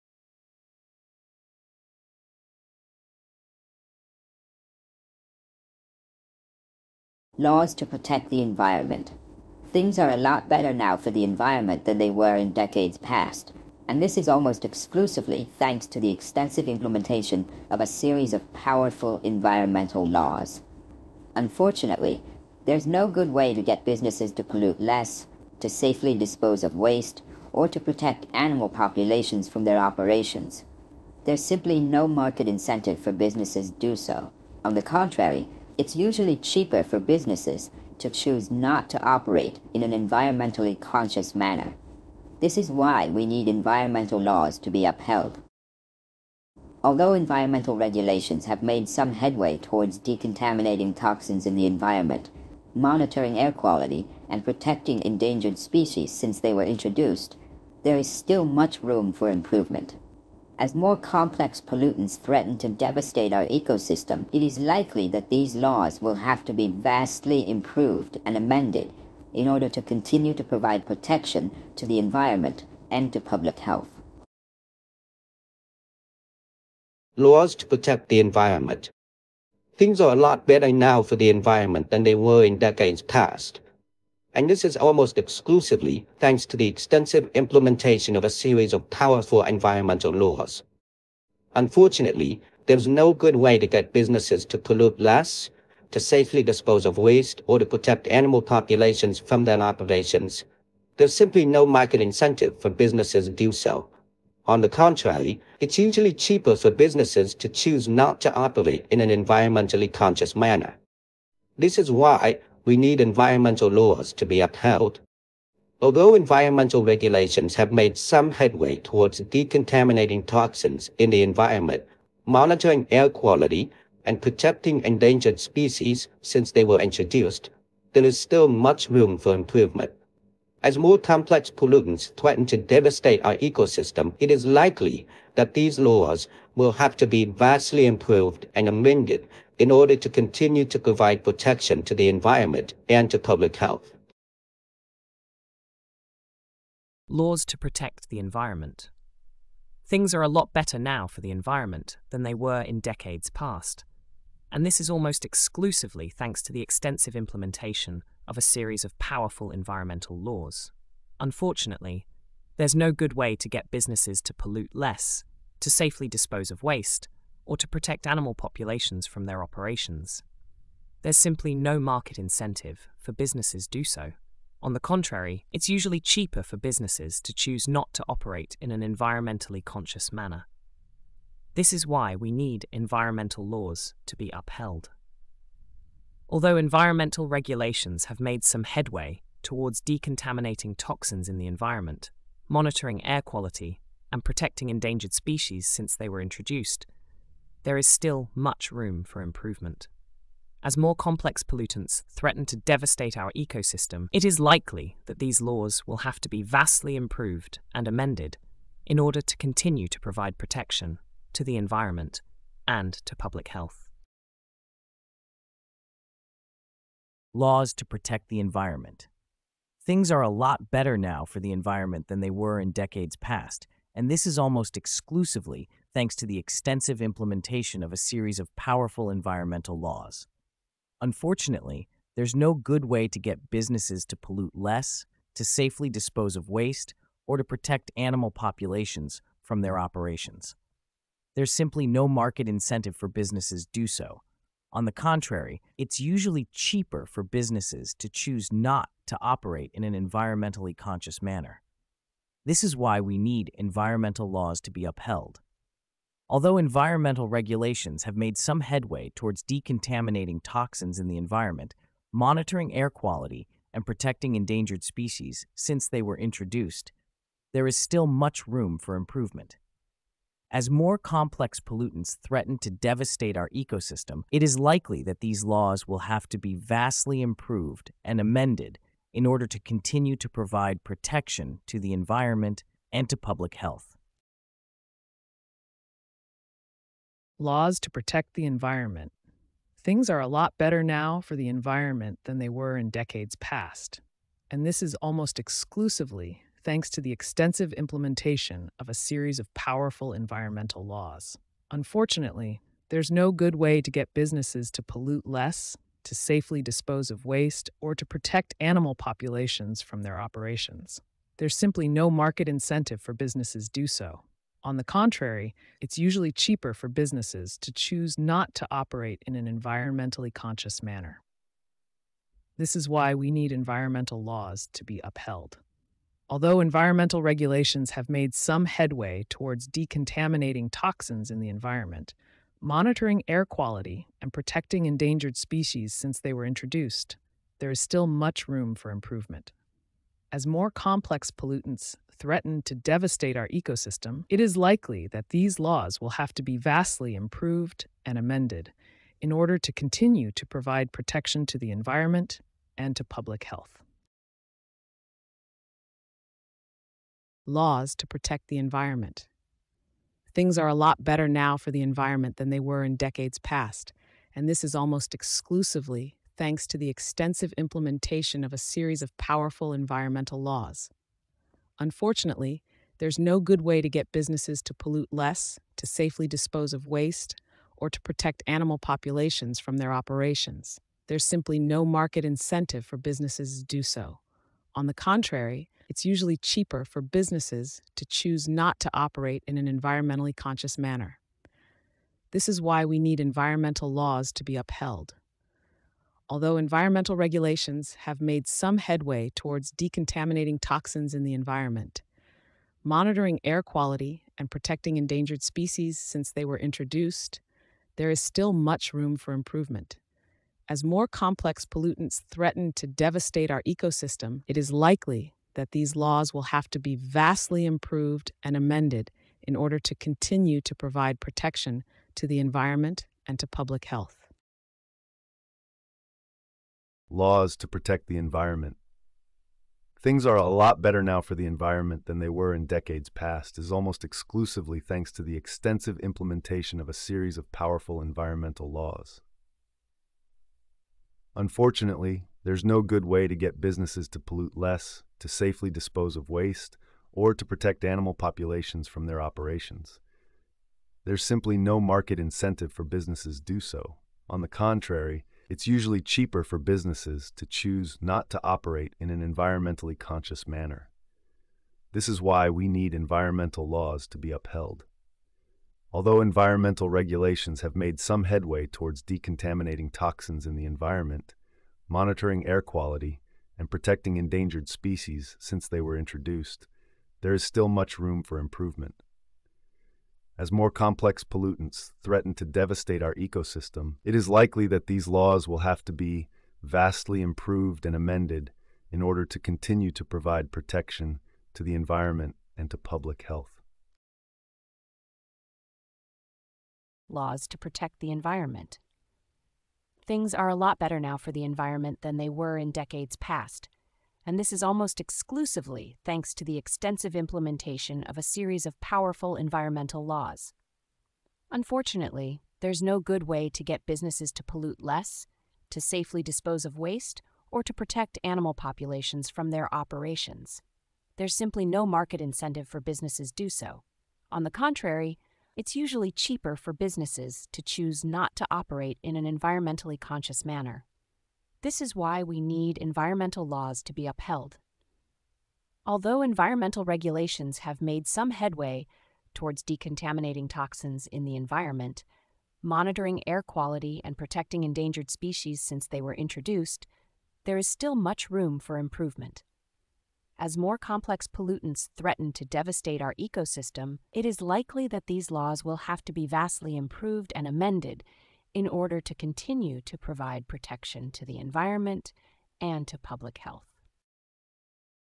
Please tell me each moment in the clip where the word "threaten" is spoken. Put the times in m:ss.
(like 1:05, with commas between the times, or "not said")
1:02, 2:12, 3:22, 4:32, 5:42, 6:52, 8:02, 9:11.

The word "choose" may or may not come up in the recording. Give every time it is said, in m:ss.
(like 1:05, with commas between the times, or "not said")
0:38, 1:47, 2:57, 4:08, 5:17, 6:28, 7:37, 8:47.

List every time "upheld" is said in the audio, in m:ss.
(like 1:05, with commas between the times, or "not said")
0:44, 1:54, 3:04, 4:14, 5:25, 6:34, 7:44, 8:54.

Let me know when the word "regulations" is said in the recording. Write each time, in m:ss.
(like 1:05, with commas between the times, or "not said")
0:47, 1:56, 3:07, 4:17, 5:27, 6:37, 7:46, 8:56.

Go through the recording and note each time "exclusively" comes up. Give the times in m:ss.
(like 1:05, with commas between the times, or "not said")
0:14, 1:25, 2:35, 3:44, 4:55, 6:05, 7:14, 8:24.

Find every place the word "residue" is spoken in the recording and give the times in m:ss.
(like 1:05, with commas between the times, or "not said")
not said.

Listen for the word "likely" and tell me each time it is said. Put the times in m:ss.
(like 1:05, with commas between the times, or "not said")
1:04, 2:14, 3:24, 4:34, 5:44, 6:54, 8:04, 9:14.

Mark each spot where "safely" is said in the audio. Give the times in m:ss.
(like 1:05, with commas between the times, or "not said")
0:25, 1:35, 2:45, 3:55, 5:06, 6:15, 7:25, 8:35.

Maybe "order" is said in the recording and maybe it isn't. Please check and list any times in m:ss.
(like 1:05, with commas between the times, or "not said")
1:09, 2:19, 3:28, 4:39, 5:49, 6:59, 8:09, 9:18.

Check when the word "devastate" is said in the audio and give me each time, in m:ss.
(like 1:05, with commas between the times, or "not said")
1:02, 2:12, 3:22, 4:32, 5:42, 6:52, 8:02, 9:12.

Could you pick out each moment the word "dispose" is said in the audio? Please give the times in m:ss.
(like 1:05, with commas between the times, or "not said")
0:26, 1:36, 2:46, 3:55, 5:06, 6:16, 7:25, 8:36.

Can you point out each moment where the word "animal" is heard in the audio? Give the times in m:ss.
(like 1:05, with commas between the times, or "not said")
0:28, 1:38, 2:48, 3:57, 5:08, 6:18, 7:27, 8:38.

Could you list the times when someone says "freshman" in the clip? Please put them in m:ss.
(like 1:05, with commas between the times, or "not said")
not said.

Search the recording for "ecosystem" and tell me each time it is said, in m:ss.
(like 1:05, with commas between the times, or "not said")
1:03, 2:13, 3:23, 4:33, 5:43, 6:53, 8:03, 9:13.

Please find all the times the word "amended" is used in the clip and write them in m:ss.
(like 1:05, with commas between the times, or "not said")
1:08, 2:18, 3:27, 4:38, 5:48, 6:58, 8:07, 9:17.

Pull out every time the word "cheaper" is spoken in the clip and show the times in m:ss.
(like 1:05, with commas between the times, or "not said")
0:36, 1:46, 2:55, 4:06, 5:16, 6:26, 7:35, 8:46.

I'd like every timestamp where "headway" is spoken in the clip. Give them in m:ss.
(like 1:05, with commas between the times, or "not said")
0:49, 1:58, 3:08, 4:18, 5:28, 6:38, 7:48, 8:58.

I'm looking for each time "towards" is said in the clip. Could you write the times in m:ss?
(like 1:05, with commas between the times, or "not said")
0:49, 1:58, 3:09, 4:19, 5:29, 6:39, 7:48, 8:59.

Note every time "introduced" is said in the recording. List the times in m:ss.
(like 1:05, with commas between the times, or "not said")
0:56, 2:06, 3:16, 4:26, 5:36, 6:46, 7:55, 9:06.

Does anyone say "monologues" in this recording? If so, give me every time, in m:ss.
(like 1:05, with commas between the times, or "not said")
not said.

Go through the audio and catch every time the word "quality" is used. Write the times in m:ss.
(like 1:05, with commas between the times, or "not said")
0:53, 2:03, 3:13, 4:22, 5:33, 6:43, 7:52, 9:03.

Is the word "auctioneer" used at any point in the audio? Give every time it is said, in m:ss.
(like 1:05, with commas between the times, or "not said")
not said.